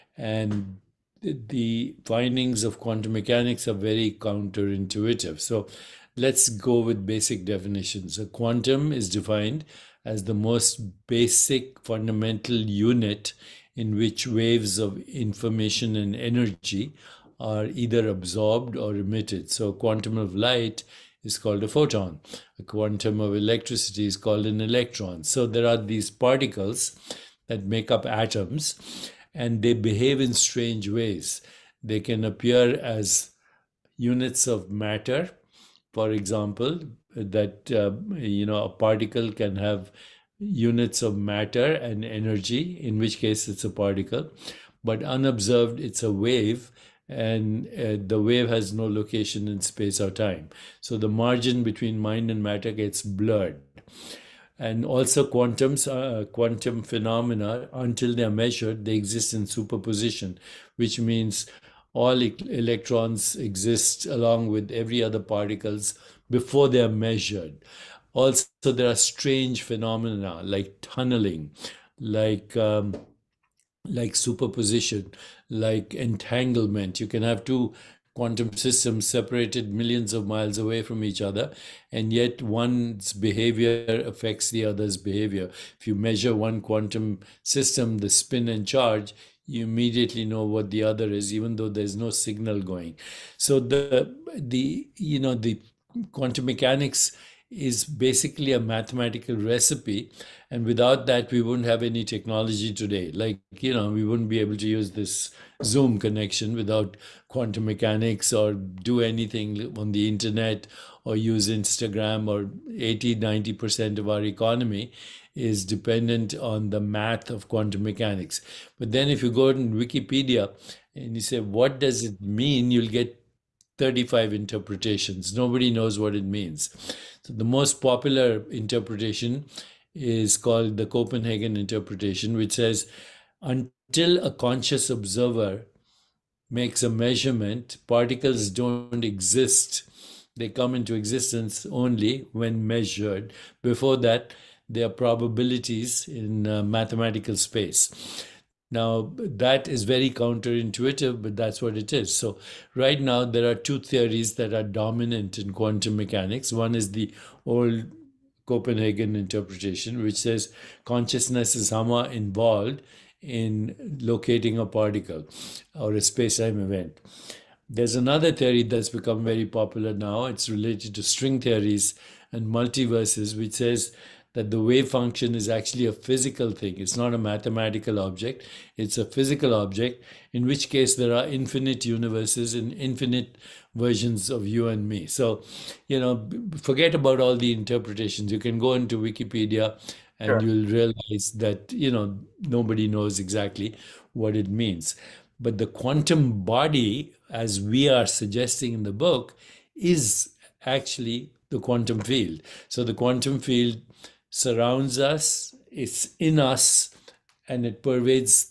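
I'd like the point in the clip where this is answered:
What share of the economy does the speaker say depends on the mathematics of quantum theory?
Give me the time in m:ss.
1:52.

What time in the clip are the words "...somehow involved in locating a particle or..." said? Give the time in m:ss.
2:41.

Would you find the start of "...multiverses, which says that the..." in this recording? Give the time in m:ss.
2:52.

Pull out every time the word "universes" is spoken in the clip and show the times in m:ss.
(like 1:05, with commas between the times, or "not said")
3:01.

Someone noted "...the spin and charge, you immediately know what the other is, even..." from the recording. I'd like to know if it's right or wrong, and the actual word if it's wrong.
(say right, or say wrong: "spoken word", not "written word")
right.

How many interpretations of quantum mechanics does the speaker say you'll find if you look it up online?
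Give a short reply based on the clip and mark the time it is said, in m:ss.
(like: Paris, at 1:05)
35, at 2:03.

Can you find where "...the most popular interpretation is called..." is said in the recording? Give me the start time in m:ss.
2:07.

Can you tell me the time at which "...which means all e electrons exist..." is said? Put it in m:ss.
1:00.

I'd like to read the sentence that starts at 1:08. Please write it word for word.
Also, there are strange phenomena like tunneling, like um, like superposition, like entanglement.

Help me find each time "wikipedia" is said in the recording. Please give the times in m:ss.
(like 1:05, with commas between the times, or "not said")
1:59, 3:08.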